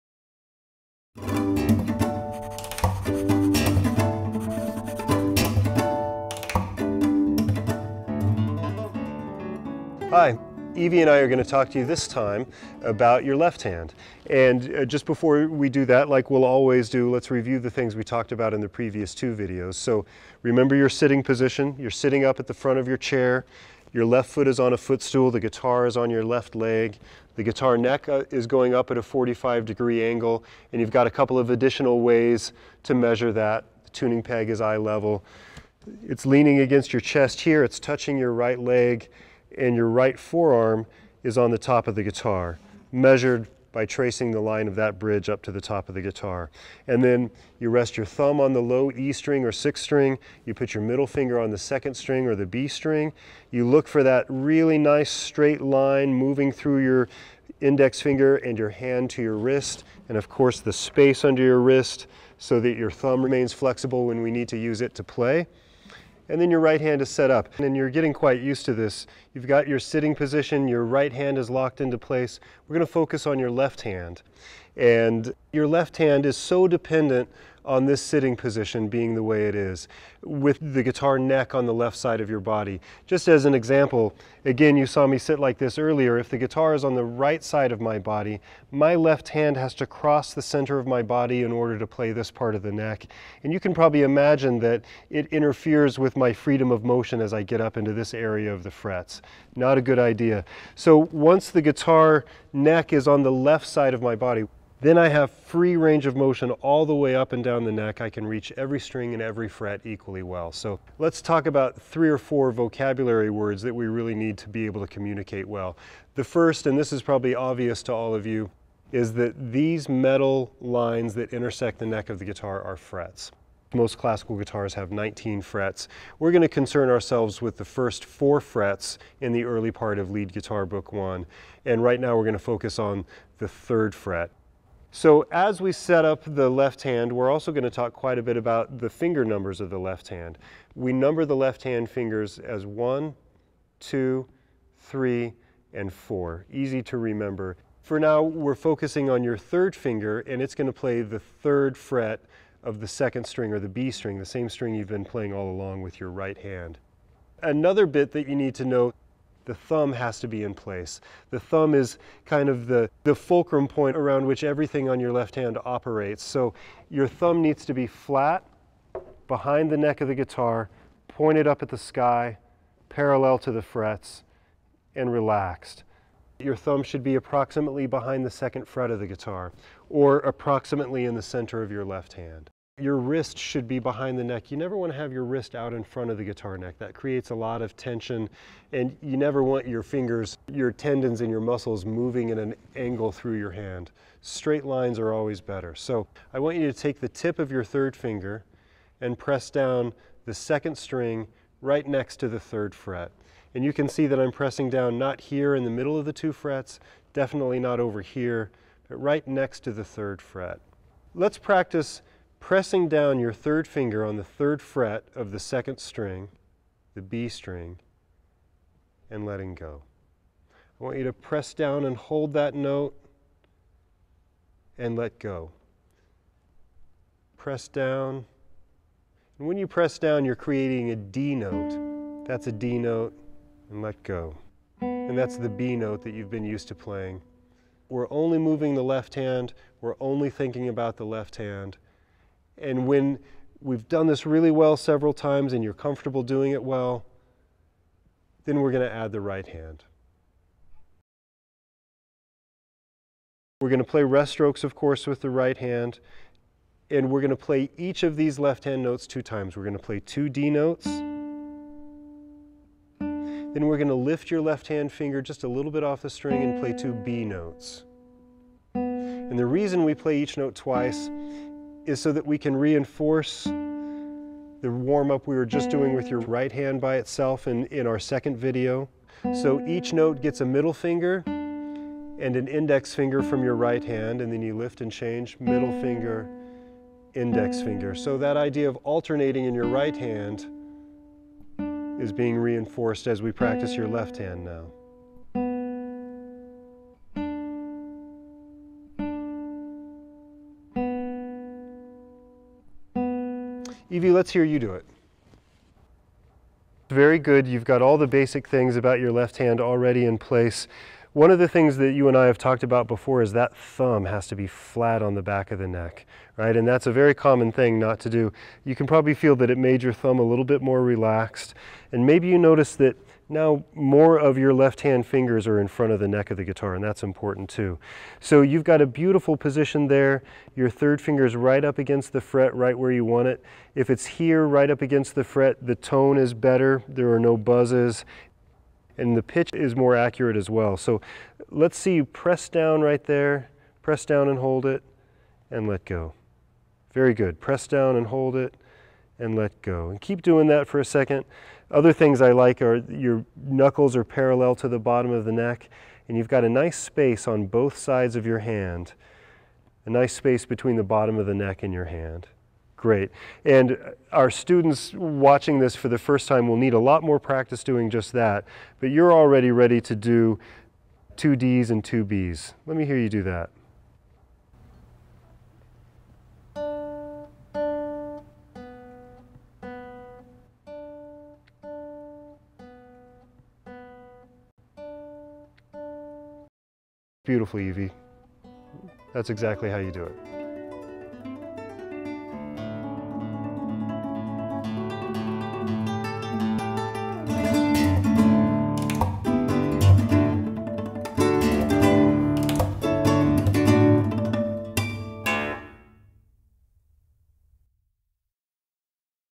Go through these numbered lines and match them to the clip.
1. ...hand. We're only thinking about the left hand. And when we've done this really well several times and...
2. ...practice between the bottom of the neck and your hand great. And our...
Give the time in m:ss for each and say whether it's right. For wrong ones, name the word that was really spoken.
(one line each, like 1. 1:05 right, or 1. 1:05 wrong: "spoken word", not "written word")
1. 3:59 right
2. 6:00 wrong: "space", not "practice".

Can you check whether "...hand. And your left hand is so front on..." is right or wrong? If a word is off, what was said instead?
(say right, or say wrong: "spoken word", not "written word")
wrong: "dependent", not "front".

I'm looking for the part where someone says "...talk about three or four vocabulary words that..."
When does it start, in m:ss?
1:51.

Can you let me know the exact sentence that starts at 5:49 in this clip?
And keep doing that for a second.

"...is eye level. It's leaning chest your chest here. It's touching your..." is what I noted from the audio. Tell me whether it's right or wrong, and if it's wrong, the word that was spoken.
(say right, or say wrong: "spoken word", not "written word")
wrong: "against", not "chest".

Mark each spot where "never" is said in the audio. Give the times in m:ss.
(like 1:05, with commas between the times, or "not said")
3:04, 3:09.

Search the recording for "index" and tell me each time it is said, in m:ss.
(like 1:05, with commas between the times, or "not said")
0:57, 4:42, 4:47.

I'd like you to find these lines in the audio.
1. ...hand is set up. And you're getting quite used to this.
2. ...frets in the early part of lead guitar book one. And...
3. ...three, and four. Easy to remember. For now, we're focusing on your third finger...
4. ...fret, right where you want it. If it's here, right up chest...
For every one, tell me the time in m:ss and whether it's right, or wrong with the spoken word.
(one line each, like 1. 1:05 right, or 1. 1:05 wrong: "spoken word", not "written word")
1. 1:06 right
2. 2:08 right
3. 2:24 right
4. 5:32 wrong: "against", not "chest".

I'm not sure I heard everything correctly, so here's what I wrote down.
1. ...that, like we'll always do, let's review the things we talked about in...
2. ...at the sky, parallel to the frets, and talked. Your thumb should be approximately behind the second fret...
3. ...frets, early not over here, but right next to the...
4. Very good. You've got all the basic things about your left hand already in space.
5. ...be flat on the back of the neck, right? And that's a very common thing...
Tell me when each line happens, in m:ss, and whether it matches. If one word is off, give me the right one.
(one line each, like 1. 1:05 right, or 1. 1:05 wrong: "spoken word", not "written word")
1. 0:15 right
2. 2:51 wrong: "relaxed", not "talked"
3. 3:26 wrong: "definitely", not "early"
4. 5:06 wrong: "place", not "space"
5. 5:14 right.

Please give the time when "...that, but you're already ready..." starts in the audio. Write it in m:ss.
6:08.